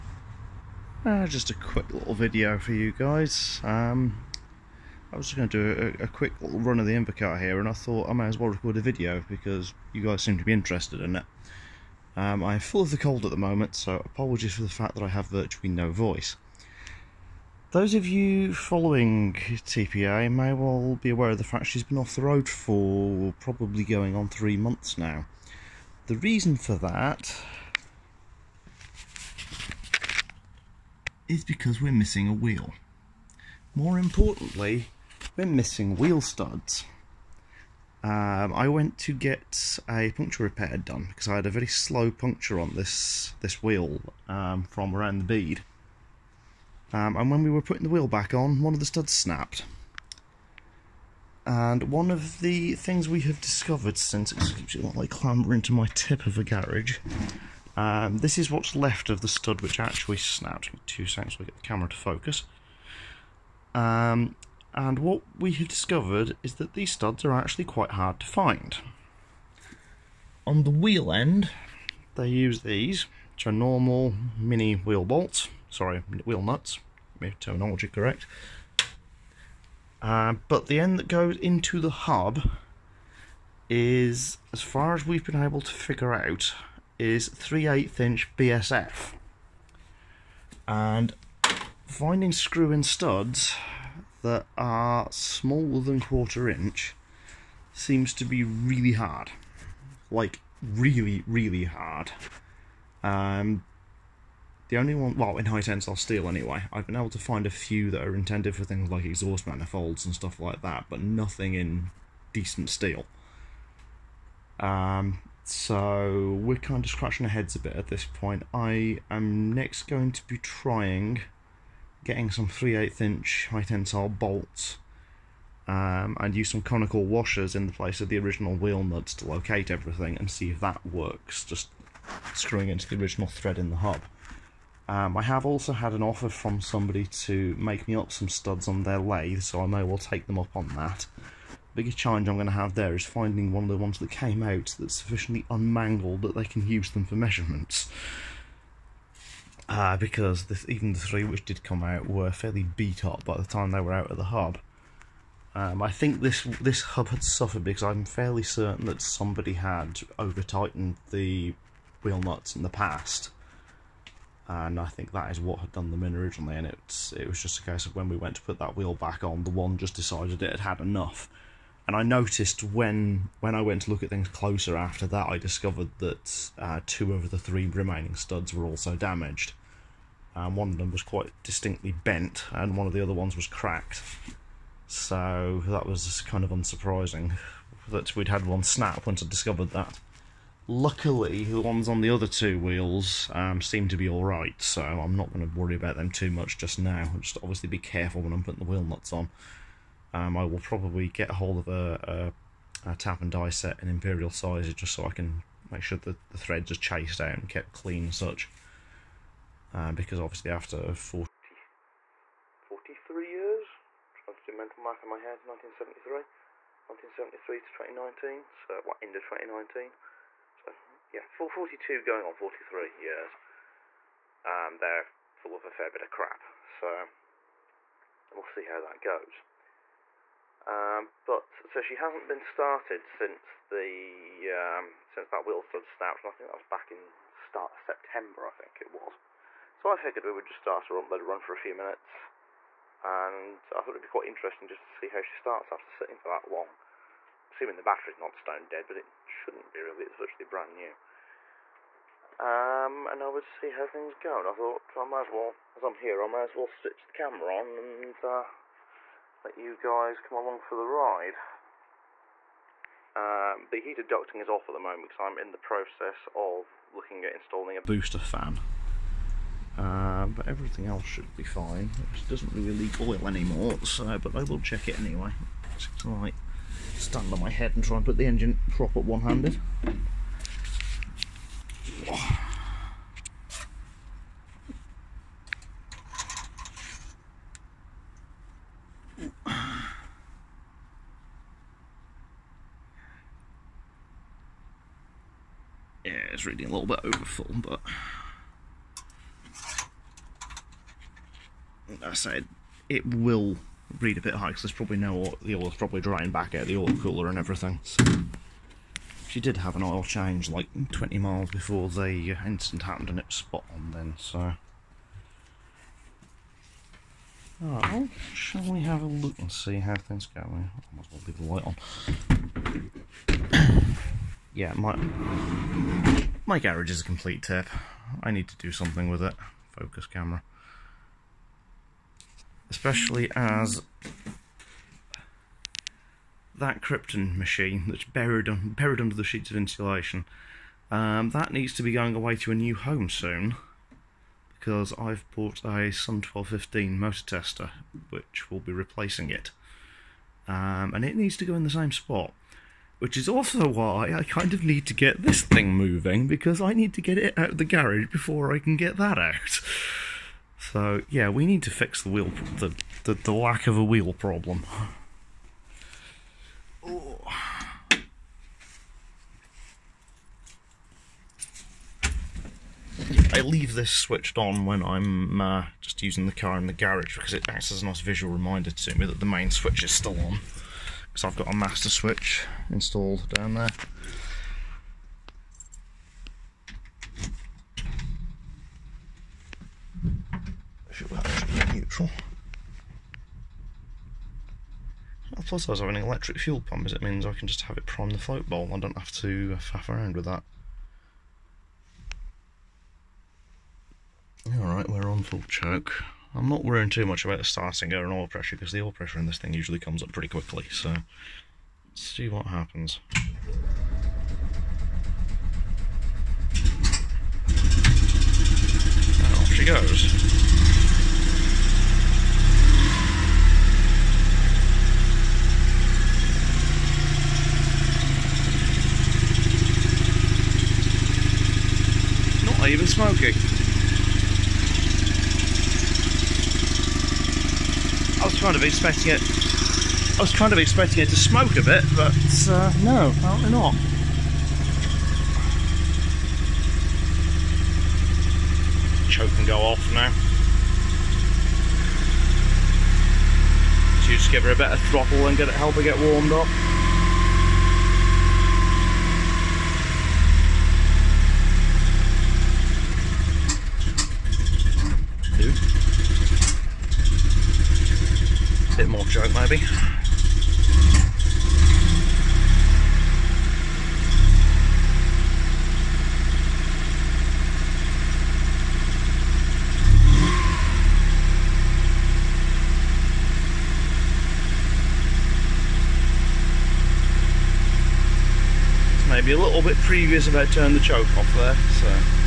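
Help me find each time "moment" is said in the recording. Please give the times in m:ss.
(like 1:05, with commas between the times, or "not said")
0:13, 4:24.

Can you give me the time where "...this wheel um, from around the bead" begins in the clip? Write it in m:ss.
0:43.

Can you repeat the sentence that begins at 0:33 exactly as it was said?
More importantly, we're missing wheel studs.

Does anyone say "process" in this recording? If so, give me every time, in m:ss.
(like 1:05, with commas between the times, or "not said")
4:25.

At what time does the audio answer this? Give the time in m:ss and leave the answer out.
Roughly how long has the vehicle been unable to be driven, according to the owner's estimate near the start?
0:24.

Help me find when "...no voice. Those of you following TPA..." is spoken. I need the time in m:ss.
0:15.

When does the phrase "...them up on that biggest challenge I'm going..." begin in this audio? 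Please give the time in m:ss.
2:20.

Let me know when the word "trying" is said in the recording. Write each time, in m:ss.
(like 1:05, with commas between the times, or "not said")
2:00, 3:34.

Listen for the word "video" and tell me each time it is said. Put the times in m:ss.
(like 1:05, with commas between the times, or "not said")
0:02, 0:08.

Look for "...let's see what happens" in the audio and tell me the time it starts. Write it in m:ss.
6:50.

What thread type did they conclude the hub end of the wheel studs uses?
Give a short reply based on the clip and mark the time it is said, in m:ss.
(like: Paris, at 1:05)
3/8 inch BSF, at 1:27.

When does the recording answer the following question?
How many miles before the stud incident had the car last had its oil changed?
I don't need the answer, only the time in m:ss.
5:10.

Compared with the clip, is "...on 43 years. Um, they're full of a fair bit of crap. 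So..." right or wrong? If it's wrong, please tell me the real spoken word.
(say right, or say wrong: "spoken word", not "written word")
right.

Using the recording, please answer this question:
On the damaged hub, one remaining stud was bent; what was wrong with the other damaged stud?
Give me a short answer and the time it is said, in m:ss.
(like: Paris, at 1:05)
cracked, at 3:03.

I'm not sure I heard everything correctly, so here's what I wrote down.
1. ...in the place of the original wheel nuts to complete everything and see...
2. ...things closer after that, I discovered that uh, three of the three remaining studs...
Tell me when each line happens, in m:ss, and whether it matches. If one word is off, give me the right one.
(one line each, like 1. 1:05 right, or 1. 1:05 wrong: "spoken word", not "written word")
1. 2:07 wrong: "locate", not "complete"
2. 2:54 wrong: "two", not "three".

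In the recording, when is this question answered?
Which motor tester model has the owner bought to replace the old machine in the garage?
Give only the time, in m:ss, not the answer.
5:45.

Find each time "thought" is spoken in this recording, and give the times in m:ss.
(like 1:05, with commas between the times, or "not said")
0:07, 4:03, 4:14.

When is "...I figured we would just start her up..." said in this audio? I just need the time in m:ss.
3:59.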